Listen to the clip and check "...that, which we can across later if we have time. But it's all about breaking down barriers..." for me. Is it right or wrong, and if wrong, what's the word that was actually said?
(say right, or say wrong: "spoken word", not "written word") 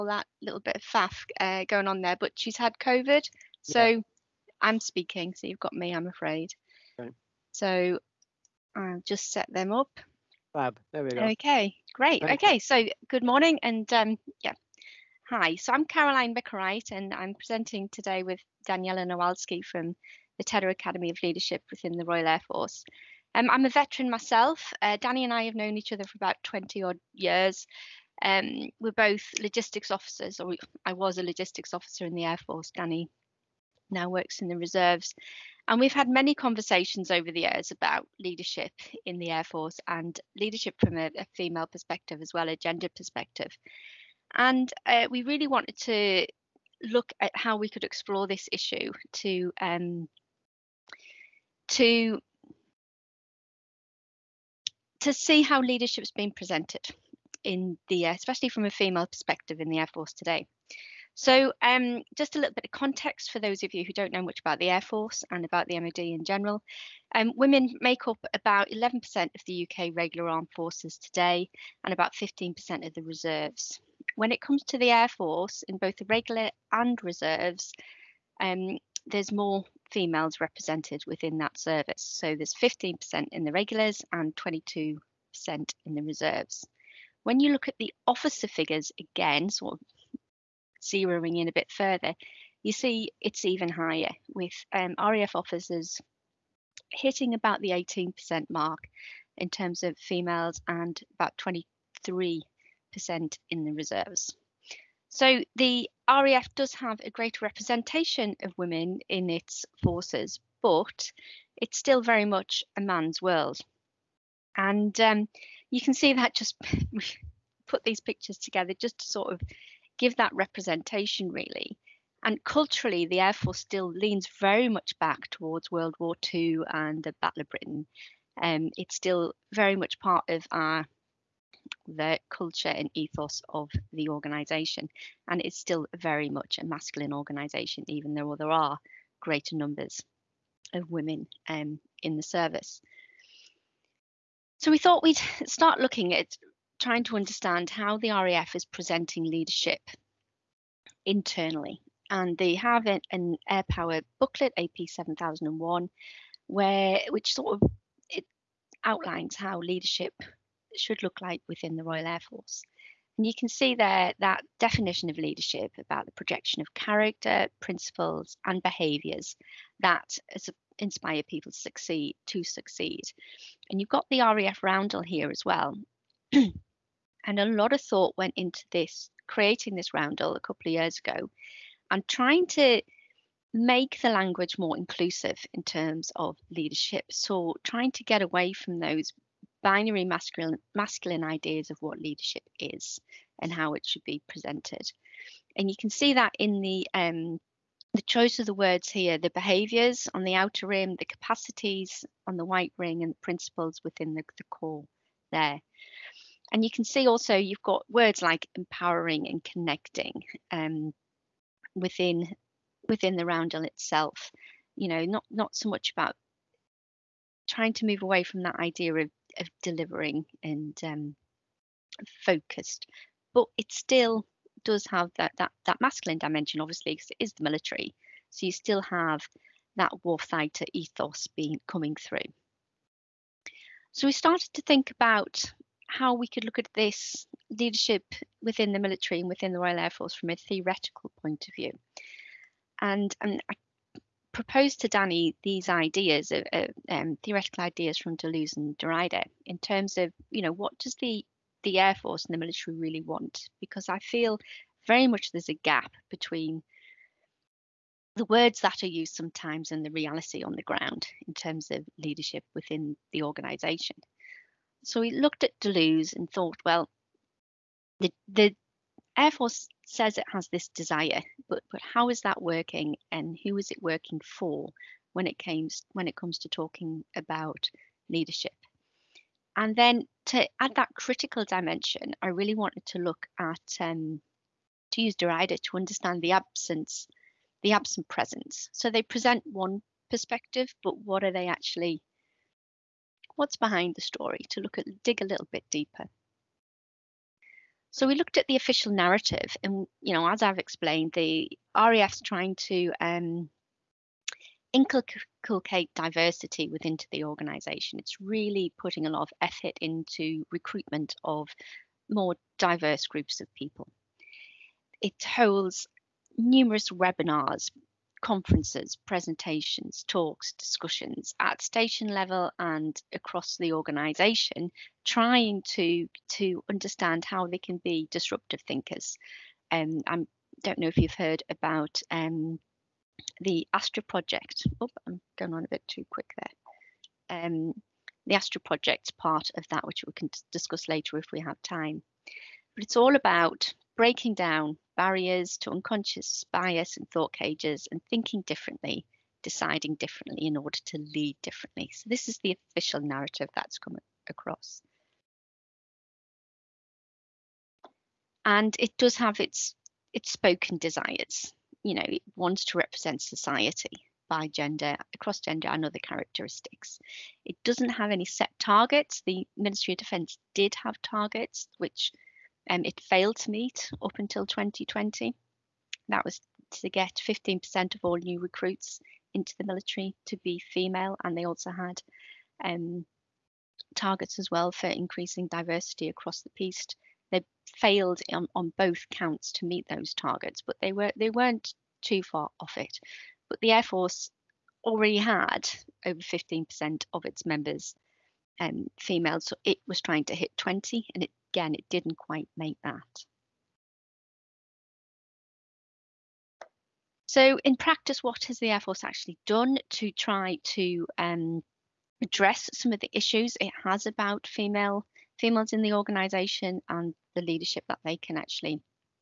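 wrong: "discuss", not "across".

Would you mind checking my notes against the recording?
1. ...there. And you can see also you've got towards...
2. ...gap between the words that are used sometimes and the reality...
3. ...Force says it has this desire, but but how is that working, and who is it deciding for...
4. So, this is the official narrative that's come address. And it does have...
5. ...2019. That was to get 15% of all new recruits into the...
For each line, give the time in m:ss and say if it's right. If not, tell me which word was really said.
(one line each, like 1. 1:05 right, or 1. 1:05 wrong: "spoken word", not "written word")
1. 3:25 wrong: "words", not "towards"
2. 4:15 right
3. 4:29 wrong: "working", not "deciding"
4. 5:51 wrong: "across", not "address"
5. 6:14 wrong: "2020", not "2019".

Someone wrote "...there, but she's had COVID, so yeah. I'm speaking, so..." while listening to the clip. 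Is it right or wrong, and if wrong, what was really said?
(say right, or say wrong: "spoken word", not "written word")
right.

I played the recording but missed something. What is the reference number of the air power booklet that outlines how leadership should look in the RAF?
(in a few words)
AP 7001.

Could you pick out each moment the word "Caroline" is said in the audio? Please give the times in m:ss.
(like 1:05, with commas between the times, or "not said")
0:15.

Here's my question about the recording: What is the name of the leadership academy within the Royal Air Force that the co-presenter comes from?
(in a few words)
Tedder Academy of Leadership.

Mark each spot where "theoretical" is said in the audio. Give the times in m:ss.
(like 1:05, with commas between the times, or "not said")
4:00, 4:07.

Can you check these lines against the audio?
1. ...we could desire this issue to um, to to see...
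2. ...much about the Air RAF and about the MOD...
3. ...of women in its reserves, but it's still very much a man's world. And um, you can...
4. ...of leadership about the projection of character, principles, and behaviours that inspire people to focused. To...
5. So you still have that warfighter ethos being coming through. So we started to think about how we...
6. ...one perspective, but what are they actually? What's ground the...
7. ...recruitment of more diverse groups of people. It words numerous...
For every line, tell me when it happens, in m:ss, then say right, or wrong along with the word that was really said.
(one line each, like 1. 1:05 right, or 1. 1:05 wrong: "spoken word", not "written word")
1. 0:47 wrong: "explore", not "desire"
2. 1:04 wrong: "Force", not "RAF"
3. 1:48 wrong: "forces", not "reserves"
4. 2:45 wrong: "succeed", not "focused"
5. 3:48 right
6. 4:49 wrong: "behind", not "ground"
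7. 5:10 wrong: "holds", not "words".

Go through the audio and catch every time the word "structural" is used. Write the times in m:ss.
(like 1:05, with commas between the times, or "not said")
not said.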